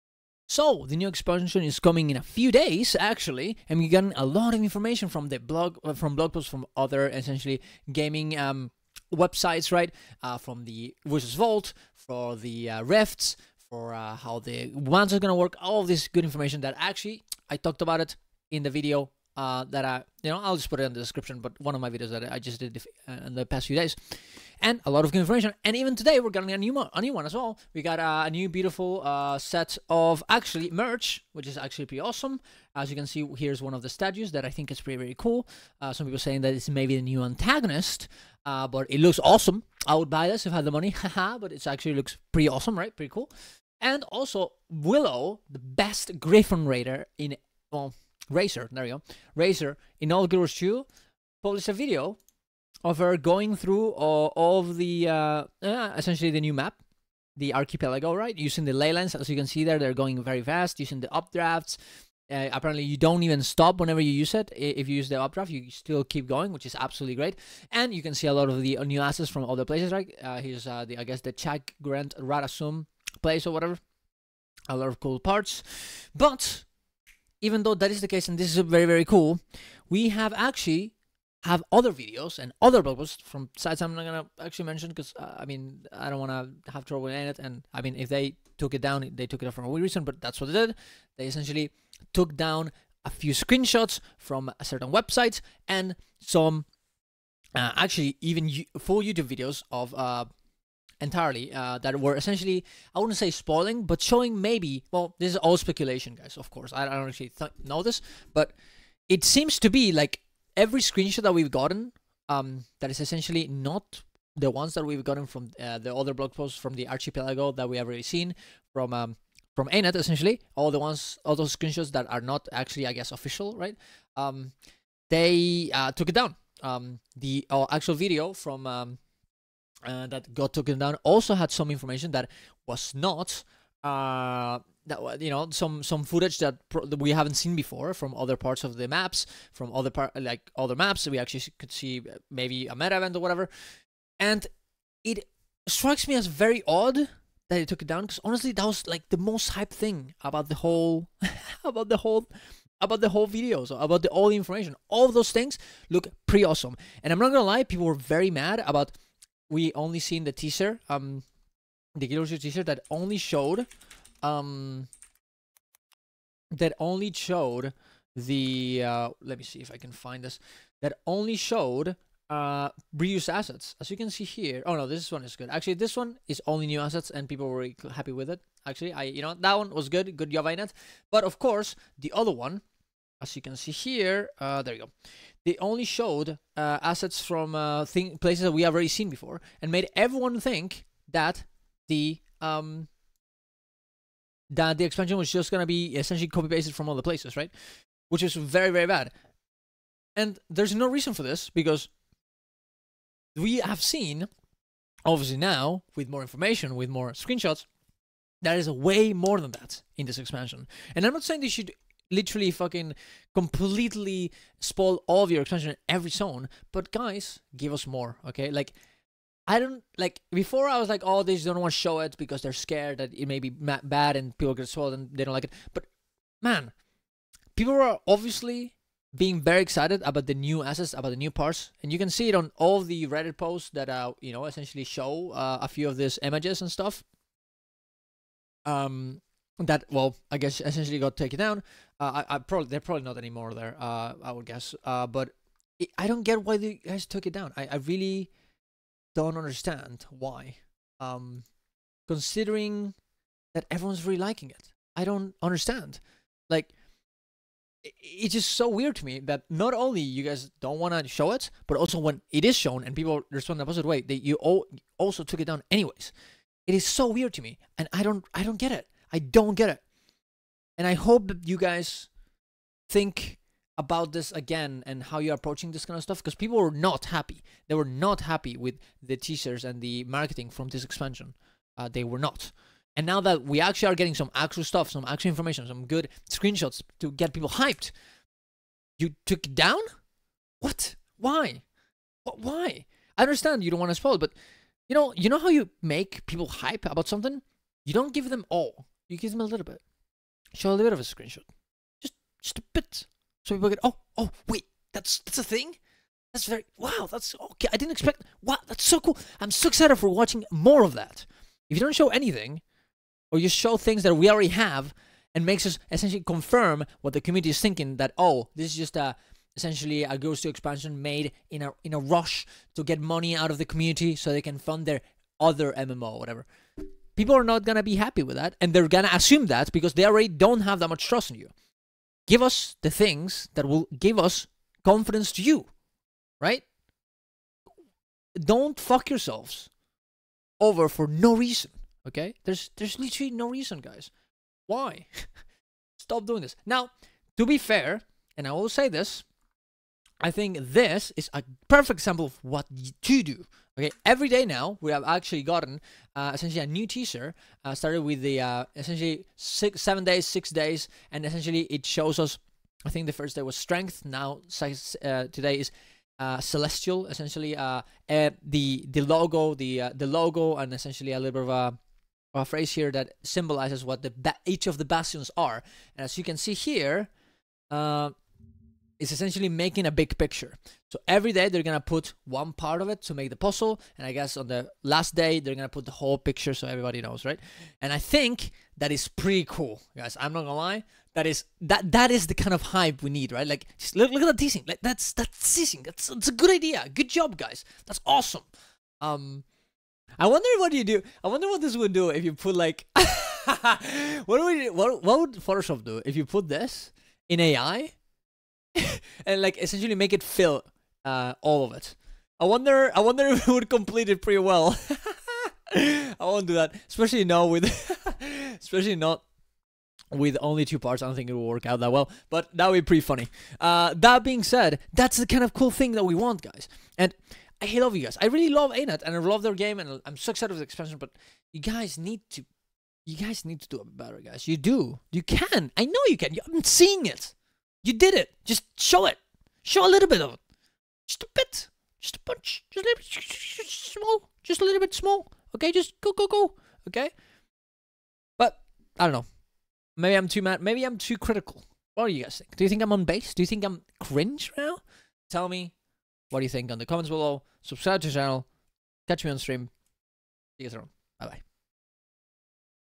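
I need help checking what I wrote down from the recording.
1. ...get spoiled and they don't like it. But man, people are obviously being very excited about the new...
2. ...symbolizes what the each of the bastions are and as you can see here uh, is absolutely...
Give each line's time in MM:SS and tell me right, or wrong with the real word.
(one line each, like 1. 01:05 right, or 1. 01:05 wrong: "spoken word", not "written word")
1. 03:44 right
2. 06:13 wrong: "essentially", not "absolutely".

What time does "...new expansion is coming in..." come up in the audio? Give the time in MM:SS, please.
00:00.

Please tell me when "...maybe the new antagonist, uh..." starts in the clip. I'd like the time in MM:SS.
00:36.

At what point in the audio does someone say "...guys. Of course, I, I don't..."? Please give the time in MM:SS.
01:46.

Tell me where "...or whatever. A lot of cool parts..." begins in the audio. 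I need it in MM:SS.
01:13.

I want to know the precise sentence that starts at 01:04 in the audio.
If you use the updraft, you still keep going, which is absolutely great.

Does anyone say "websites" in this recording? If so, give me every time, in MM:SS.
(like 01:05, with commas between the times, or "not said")
00:09, 01:34.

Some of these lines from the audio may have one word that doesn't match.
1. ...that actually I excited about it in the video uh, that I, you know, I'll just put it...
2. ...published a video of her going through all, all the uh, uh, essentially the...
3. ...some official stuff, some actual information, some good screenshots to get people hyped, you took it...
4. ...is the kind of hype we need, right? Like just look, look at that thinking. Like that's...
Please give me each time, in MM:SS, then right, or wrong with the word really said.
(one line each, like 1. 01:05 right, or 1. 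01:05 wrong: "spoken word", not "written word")
1. 00:16 wrong: "talked", not "excited"
2. 00:51 right
3. 04:44 wrong: "actual", not "official"
4. 06:32 wrong: "teasing", not "thinking".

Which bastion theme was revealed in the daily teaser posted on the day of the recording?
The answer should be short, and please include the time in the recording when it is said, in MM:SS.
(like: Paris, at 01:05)
celestial, at 06:06.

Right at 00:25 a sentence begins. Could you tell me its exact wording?
And even today, we're getting a new, mo- a new one as well.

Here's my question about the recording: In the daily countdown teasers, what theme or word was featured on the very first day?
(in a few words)
strength.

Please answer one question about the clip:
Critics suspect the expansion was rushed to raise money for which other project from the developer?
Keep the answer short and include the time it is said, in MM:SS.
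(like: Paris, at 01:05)
their other MMO, at 05:24.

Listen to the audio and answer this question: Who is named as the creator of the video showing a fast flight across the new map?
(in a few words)
Willow.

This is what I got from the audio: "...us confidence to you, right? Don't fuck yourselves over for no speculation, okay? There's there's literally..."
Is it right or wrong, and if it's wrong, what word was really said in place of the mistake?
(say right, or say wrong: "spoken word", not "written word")
wrong: "reason", not "speculation".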